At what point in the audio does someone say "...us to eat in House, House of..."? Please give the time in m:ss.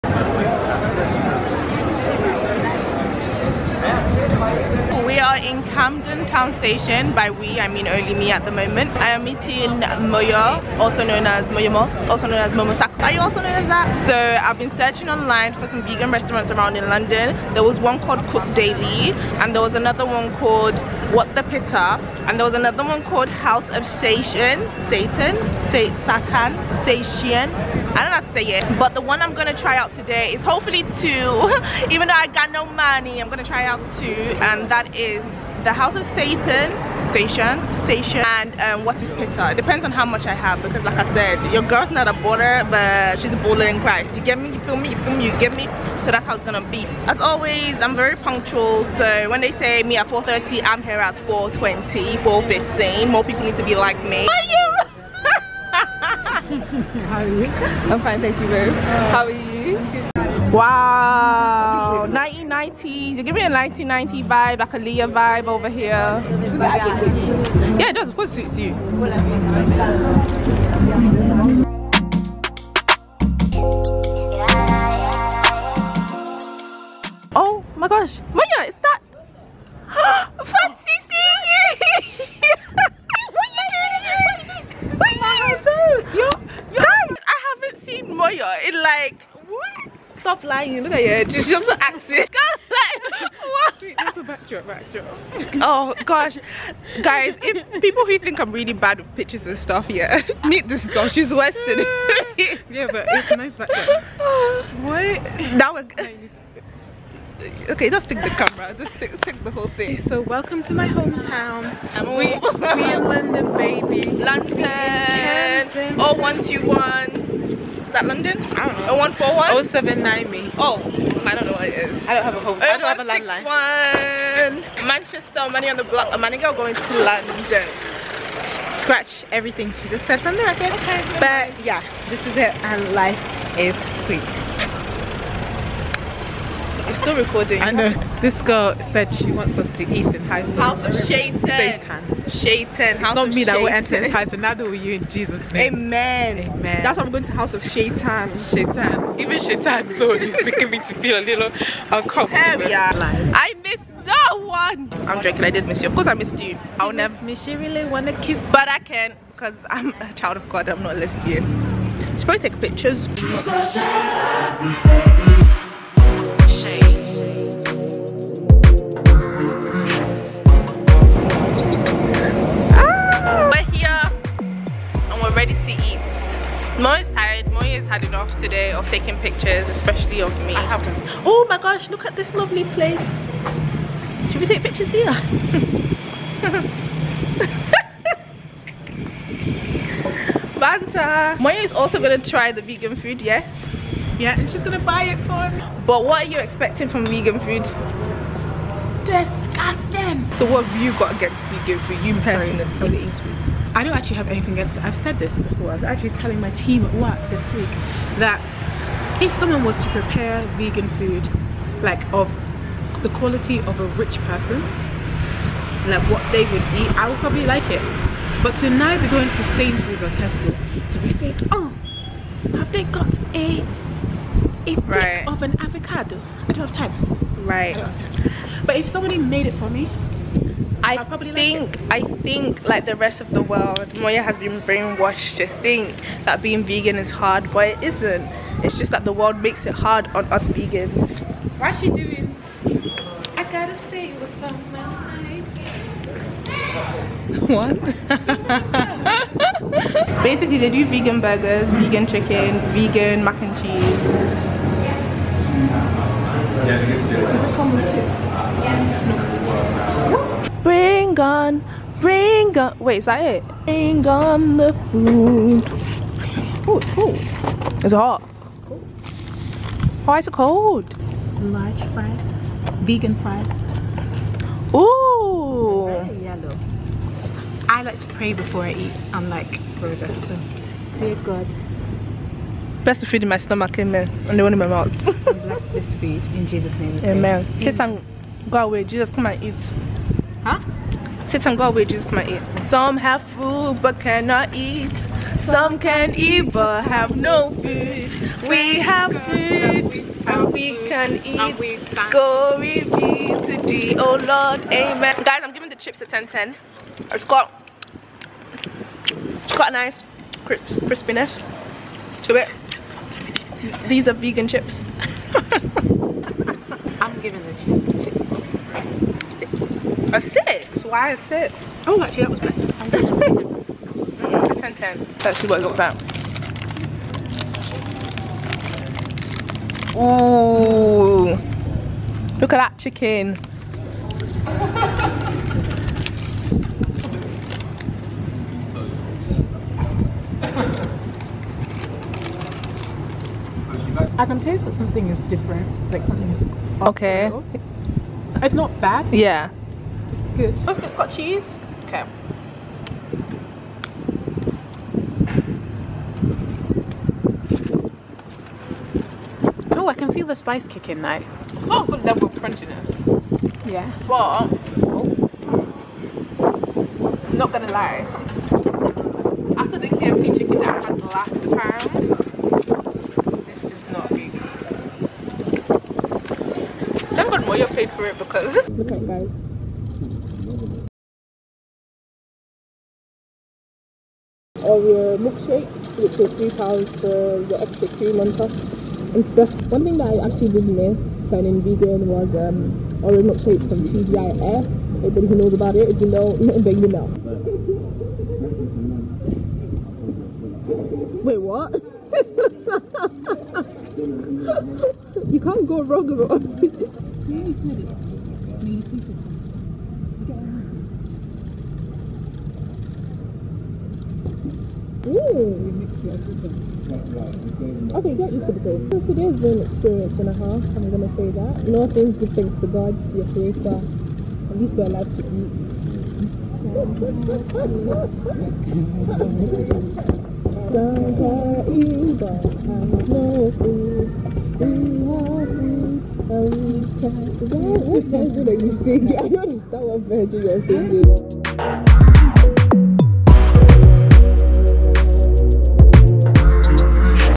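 2:19.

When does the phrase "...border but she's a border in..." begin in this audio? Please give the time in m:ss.
0:42.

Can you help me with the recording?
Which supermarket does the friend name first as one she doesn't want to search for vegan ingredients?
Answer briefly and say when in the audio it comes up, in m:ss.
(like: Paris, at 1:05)
Sainsbury's, at 3:39.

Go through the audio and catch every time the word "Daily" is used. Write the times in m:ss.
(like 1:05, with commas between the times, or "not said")
0:18.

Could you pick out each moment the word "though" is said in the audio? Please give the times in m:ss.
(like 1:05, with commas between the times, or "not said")
0:32, 6:01.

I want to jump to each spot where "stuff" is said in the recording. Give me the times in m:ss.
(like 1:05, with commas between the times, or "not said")
1:39, 6:29.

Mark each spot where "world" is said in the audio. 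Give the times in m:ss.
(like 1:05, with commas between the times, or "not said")
3:53, 3:59.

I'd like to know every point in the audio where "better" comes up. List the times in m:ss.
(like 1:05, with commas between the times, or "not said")
5:22.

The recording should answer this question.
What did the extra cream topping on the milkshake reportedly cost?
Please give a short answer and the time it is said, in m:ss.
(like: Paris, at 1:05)
£3, at 6:26.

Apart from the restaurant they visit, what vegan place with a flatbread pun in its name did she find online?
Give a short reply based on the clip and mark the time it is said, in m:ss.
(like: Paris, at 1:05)
What the Pitta, at 0:21.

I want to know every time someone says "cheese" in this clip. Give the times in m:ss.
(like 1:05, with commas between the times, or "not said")
4:13, 5:51.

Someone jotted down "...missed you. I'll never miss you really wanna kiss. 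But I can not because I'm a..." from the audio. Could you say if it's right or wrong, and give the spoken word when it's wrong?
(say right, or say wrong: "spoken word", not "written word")
right.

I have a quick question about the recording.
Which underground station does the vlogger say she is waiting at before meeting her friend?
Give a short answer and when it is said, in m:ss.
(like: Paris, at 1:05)
Camden Town, at 0:05.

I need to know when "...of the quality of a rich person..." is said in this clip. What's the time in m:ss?
3:32.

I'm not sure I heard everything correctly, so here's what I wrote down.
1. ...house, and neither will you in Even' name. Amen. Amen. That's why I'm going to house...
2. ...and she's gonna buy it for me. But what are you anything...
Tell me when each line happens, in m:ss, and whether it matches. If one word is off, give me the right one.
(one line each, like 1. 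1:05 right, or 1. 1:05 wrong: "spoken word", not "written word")
1. 2:24 wrong: "Jesus", not "Even"
2. 3:14 wrong: "expecting", not "anything".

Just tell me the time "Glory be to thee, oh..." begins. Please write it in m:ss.
5:02.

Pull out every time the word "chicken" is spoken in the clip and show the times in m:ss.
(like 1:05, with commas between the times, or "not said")
4:12, 5:32, 6:10.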